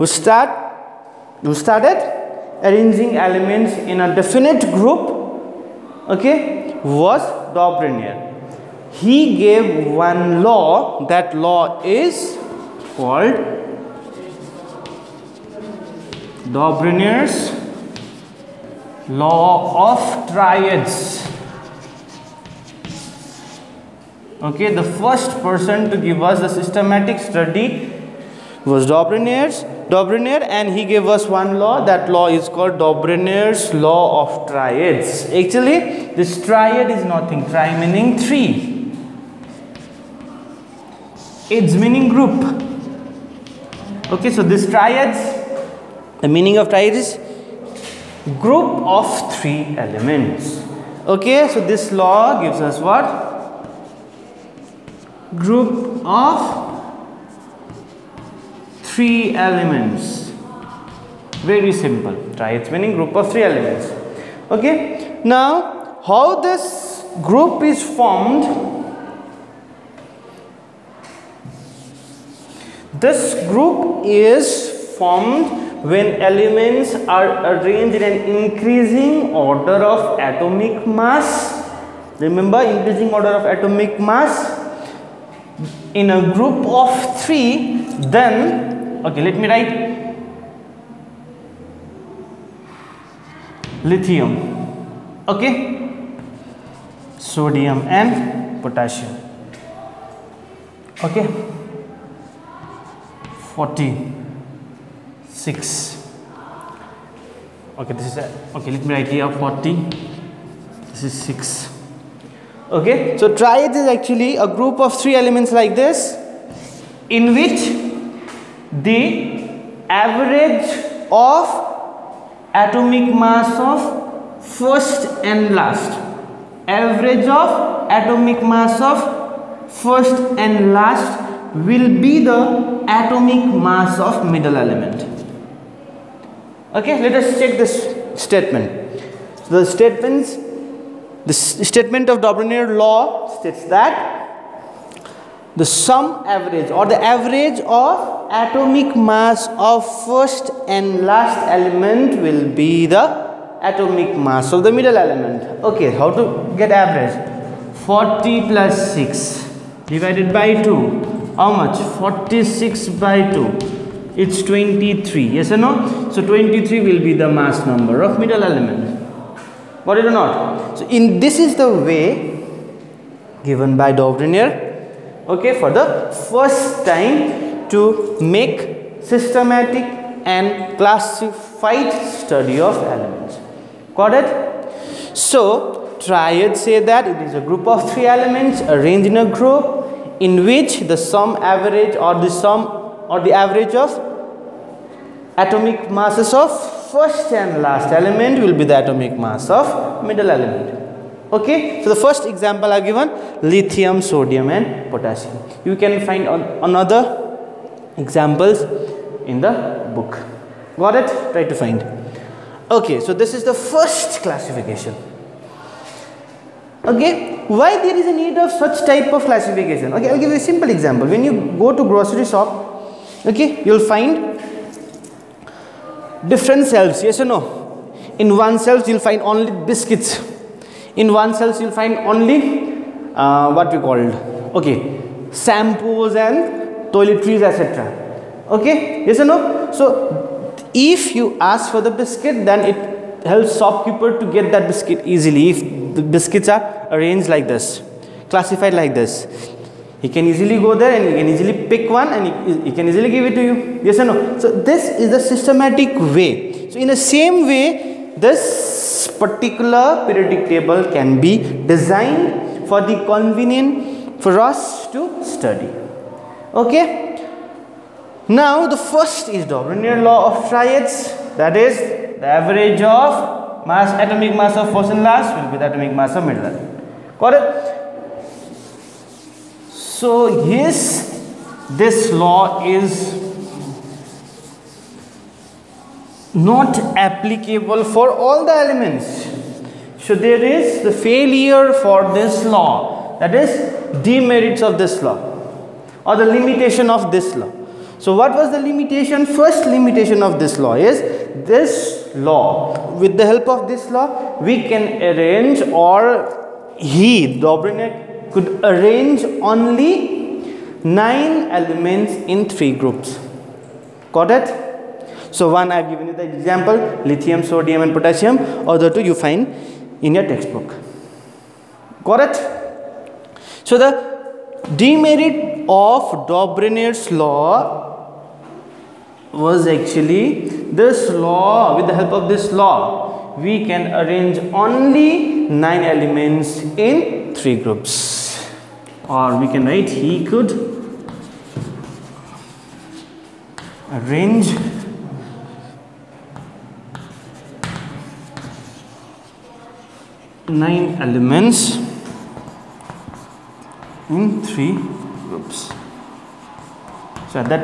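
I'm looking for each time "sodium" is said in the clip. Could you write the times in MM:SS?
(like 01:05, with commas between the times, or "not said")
01:37, 03:24, 05:17.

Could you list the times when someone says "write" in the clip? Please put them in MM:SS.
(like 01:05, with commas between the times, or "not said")
01:29, 01:48, 05:39.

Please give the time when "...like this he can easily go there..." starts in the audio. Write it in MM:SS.
04:08.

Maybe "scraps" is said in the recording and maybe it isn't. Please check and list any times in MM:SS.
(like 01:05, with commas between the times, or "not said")
not said.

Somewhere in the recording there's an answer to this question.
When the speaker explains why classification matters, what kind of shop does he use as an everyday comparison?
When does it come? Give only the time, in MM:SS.
03:41.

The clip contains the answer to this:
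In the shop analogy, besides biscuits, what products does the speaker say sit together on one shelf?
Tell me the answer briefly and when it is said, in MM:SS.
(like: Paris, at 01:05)
shampoos and toiletries, at 03:55.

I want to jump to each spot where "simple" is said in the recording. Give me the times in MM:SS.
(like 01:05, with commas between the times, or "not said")
01:01, 03:40.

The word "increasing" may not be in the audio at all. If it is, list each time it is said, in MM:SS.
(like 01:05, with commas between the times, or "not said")
01:18, 01:22.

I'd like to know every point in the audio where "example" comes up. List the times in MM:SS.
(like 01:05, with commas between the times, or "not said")
03:22, 03:28, 03:40, 05:16.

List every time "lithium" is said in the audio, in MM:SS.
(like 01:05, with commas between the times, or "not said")
01:33, 03:23, 05:17.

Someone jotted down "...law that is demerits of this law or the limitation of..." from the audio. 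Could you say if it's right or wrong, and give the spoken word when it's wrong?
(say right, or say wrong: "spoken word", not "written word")
right.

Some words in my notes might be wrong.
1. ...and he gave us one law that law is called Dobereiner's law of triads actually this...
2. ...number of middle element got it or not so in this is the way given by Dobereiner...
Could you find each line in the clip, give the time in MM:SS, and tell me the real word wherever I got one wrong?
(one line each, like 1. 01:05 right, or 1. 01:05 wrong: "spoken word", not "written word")
1. 00:30 right
2. 02:47 right.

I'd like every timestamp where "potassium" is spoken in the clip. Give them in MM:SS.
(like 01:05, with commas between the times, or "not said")
01:38, 03:24, 05:17.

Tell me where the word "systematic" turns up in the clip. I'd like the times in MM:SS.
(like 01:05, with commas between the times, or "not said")
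00:26, 02:59, 04:15.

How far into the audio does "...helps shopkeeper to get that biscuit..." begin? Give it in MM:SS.
04:03.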